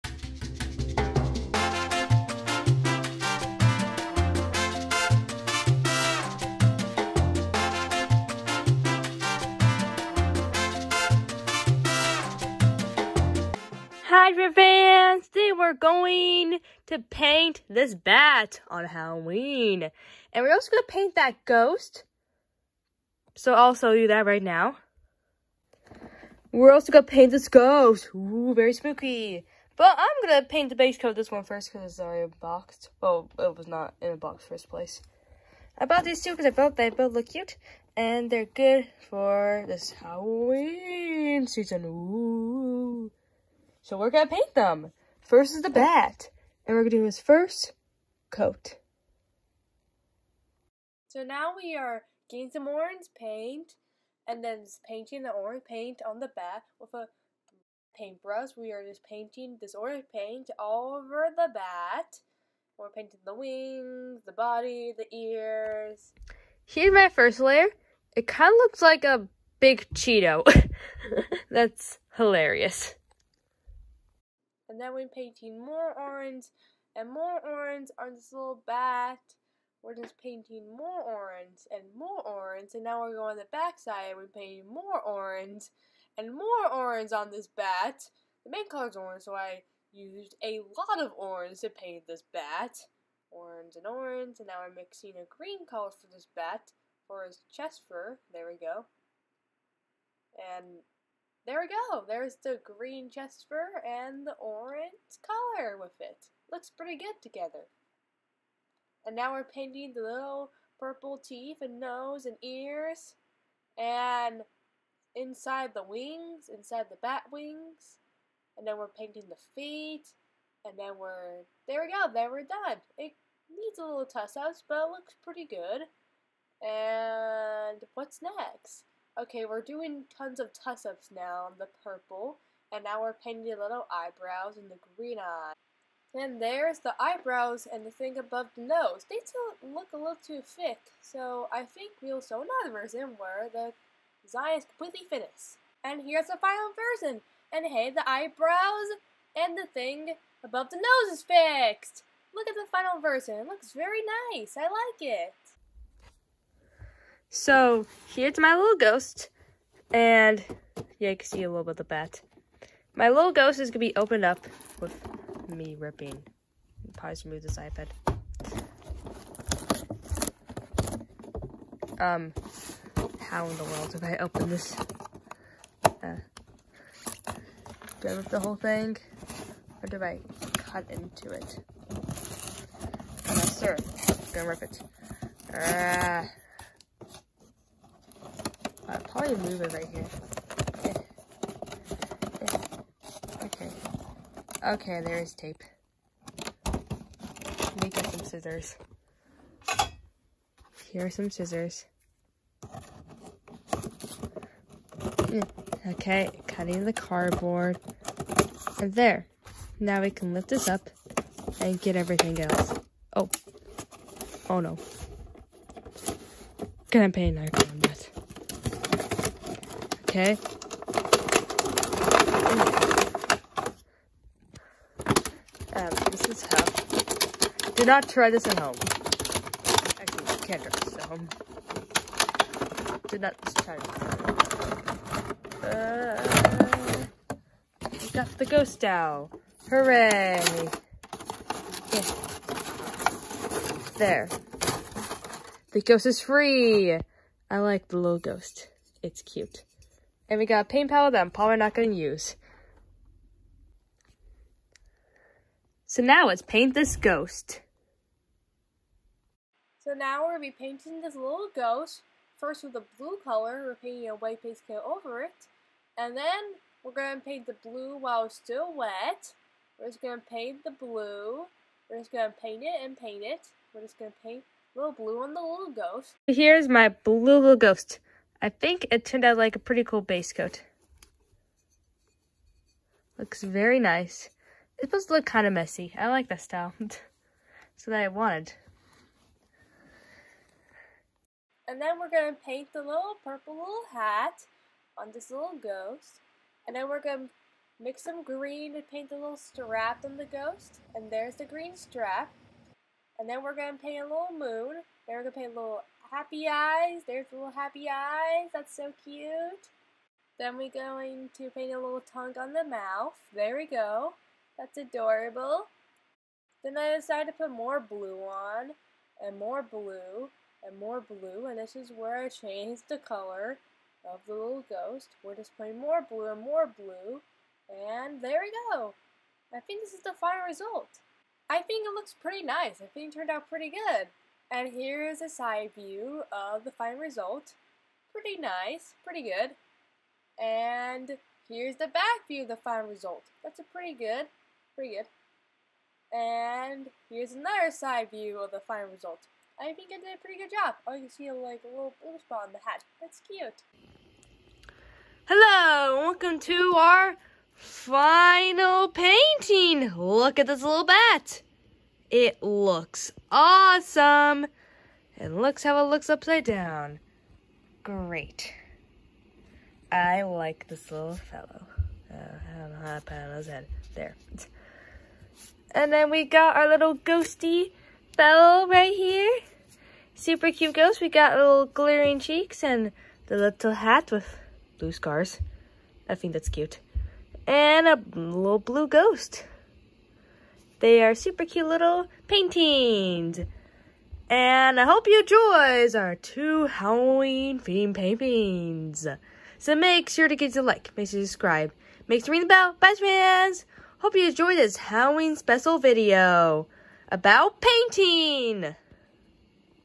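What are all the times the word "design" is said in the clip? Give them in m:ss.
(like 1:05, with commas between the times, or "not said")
2:24.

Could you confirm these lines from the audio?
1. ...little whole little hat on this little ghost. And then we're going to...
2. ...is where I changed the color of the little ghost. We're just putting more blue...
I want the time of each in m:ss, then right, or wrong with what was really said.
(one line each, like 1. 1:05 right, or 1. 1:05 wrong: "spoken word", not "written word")
1. 4:52 wrong: "purple", not "whole"
2. 5:21 right.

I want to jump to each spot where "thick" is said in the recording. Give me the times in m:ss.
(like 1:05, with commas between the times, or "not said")
2:20.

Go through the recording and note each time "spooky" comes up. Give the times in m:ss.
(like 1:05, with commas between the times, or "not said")
0:28.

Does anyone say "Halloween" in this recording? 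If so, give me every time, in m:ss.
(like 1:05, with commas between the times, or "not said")
0:18, 0:39, 6:36, 6:44.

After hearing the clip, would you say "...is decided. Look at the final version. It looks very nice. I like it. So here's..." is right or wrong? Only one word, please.
wrong.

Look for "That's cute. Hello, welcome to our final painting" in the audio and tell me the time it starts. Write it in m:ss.
5:52.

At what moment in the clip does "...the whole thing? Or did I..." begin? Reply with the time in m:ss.
2:58.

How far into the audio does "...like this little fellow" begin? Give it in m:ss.
6:10.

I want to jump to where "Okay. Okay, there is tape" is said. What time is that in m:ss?
3:13.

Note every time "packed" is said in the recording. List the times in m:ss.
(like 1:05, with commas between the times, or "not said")
not said.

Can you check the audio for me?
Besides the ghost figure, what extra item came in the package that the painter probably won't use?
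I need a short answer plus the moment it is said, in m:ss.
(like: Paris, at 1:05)
A paint palette, at 4:10.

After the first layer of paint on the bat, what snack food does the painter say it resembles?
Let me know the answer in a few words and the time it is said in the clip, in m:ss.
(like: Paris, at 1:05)
A big Cheeto, at 1:09.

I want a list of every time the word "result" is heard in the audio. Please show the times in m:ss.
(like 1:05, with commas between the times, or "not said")
5:30, 5:36, 5:42, 5:48.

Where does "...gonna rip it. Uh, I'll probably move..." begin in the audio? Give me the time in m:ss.
3:04.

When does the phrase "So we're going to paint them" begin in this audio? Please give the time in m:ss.
0:43.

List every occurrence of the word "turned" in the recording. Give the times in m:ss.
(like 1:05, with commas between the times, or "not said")
4:39, 5:33.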